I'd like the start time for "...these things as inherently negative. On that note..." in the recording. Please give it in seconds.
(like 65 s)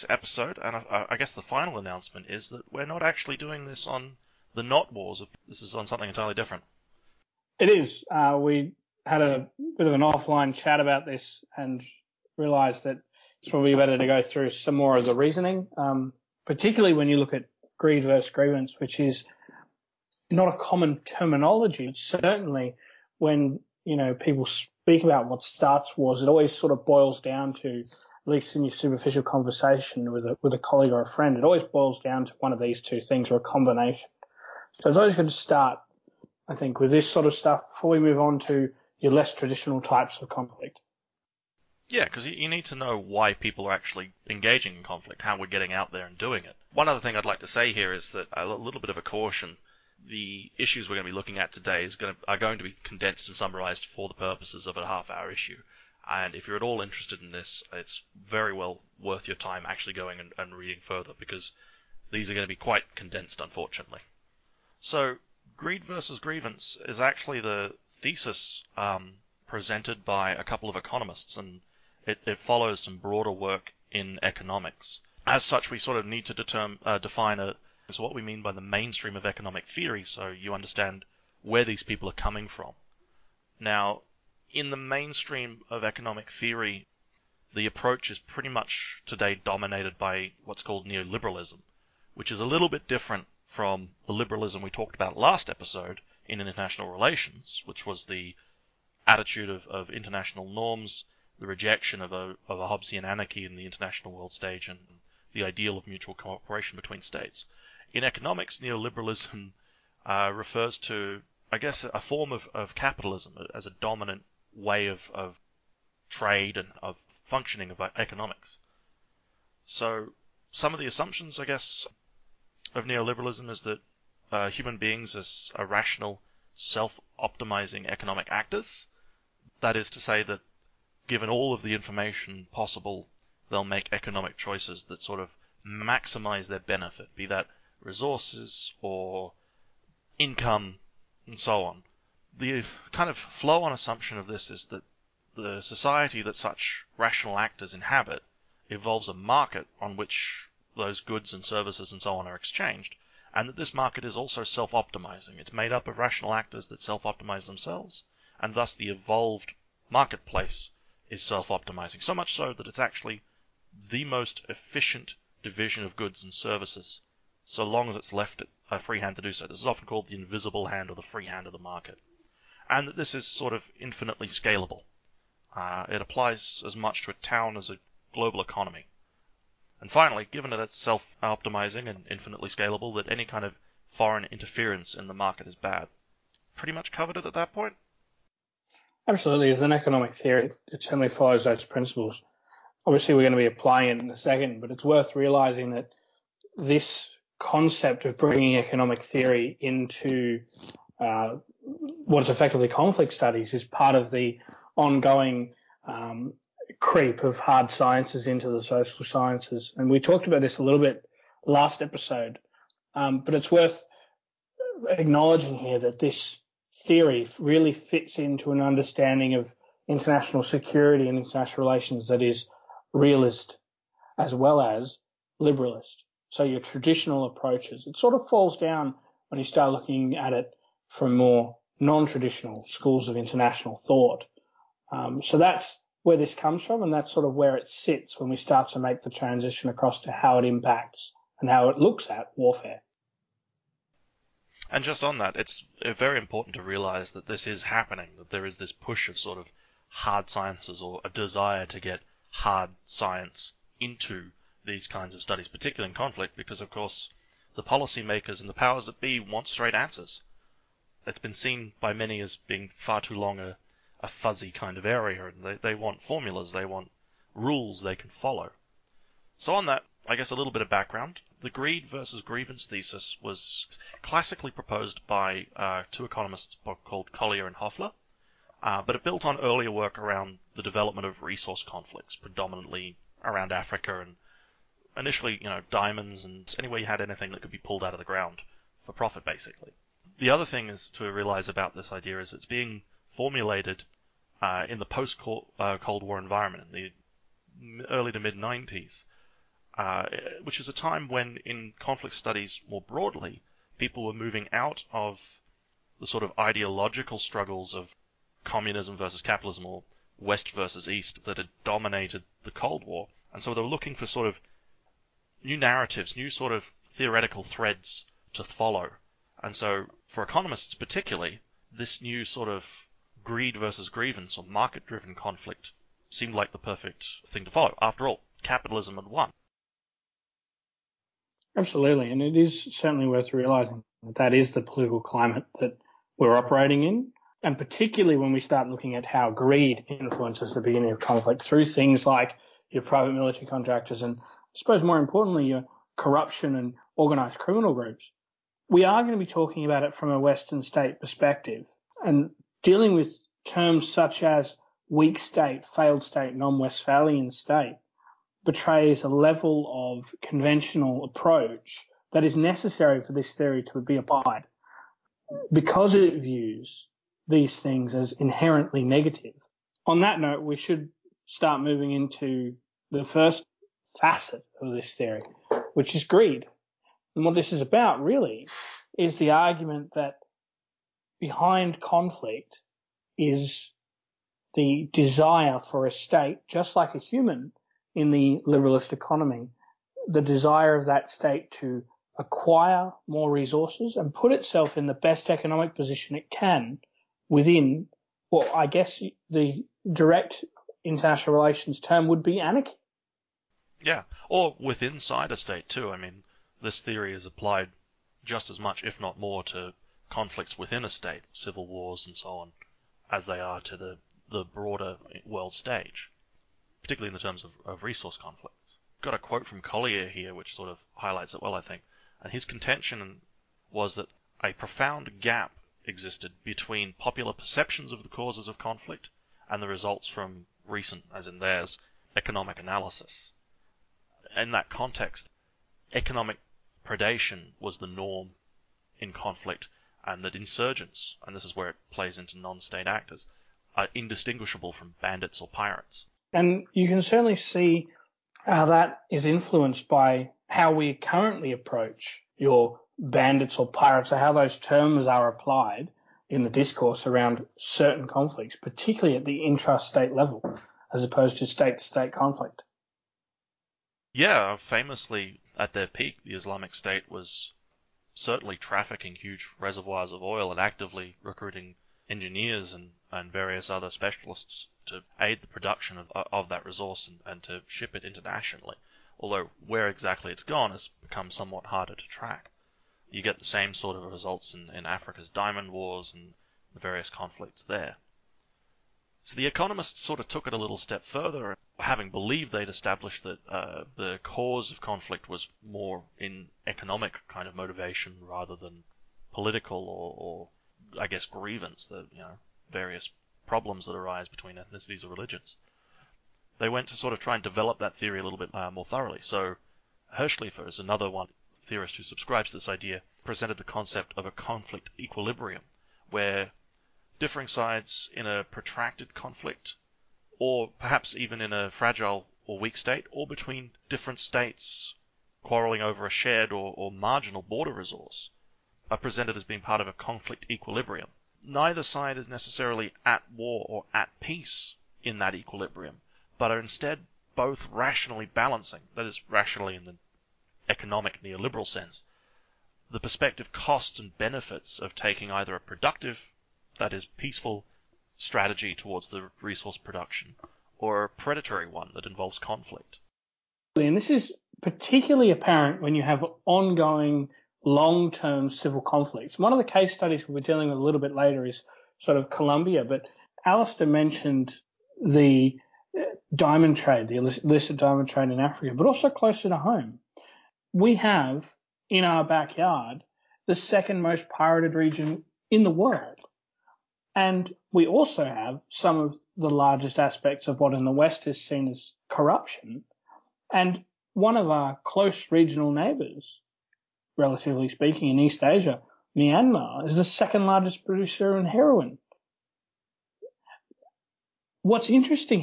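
367 s.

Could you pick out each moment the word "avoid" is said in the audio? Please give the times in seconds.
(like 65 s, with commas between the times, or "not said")
not said.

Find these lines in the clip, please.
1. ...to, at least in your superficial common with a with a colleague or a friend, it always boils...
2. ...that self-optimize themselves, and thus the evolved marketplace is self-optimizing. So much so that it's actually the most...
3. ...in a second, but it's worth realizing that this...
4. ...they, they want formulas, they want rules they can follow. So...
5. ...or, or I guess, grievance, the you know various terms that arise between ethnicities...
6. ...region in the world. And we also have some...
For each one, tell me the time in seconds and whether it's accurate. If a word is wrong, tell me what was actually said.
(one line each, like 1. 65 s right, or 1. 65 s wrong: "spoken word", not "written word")
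1. 27 s wrong: "conversation", not "common"
2. 156 s right
3. 194 s right
4. 265 s right
5. 499 s wrong: "problems", not "terms"
6. 574 s right.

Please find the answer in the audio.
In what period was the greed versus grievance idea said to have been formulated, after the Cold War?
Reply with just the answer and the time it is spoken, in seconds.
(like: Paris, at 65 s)
Early to mid 90s, at 297 s.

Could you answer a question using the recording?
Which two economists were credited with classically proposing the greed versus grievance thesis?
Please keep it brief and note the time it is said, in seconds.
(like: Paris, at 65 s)
Collier and Hoeffler, at 277 s.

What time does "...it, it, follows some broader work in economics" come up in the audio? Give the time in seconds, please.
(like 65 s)
72 s.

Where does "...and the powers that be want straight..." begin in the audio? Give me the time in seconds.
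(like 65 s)
258 s.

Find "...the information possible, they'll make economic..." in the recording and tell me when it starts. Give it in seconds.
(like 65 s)
131 s.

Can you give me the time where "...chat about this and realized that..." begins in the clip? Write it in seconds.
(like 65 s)
10 s.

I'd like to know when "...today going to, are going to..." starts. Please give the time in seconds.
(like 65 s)
51 s.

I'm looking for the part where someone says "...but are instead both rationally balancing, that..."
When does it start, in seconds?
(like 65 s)
536 s.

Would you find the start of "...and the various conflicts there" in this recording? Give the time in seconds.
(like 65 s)
486 s.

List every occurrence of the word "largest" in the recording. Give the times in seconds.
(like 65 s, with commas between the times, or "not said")
579 s, 590 s.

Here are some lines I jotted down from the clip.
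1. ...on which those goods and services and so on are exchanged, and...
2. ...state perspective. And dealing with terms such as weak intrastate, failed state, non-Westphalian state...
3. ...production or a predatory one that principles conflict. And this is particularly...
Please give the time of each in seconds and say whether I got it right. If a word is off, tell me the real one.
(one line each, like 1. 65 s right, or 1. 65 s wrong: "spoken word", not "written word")
1. 149 s right
2. 350 s wrong: "state", not "intrastate"
3. 549 s wrong: "involves", not "principles".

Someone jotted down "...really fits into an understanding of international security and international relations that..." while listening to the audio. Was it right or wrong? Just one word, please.
right.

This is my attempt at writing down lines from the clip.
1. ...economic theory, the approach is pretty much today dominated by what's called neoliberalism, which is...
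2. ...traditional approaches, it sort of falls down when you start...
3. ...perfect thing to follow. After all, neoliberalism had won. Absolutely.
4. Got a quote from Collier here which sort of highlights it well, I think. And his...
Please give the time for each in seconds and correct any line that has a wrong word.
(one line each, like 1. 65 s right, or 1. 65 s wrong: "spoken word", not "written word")
1. 85 s right
2. 226 s right
3. 326 s wrong: "capitalism", not "neoliberalism"
4. 419 s right.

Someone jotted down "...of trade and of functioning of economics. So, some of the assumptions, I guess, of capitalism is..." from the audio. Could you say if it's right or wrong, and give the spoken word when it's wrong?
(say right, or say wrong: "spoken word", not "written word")
wrong: "neoliberalism", not "capitalism".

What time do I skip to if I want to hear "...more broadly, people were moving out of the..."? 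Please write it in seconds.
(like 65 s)
302 s.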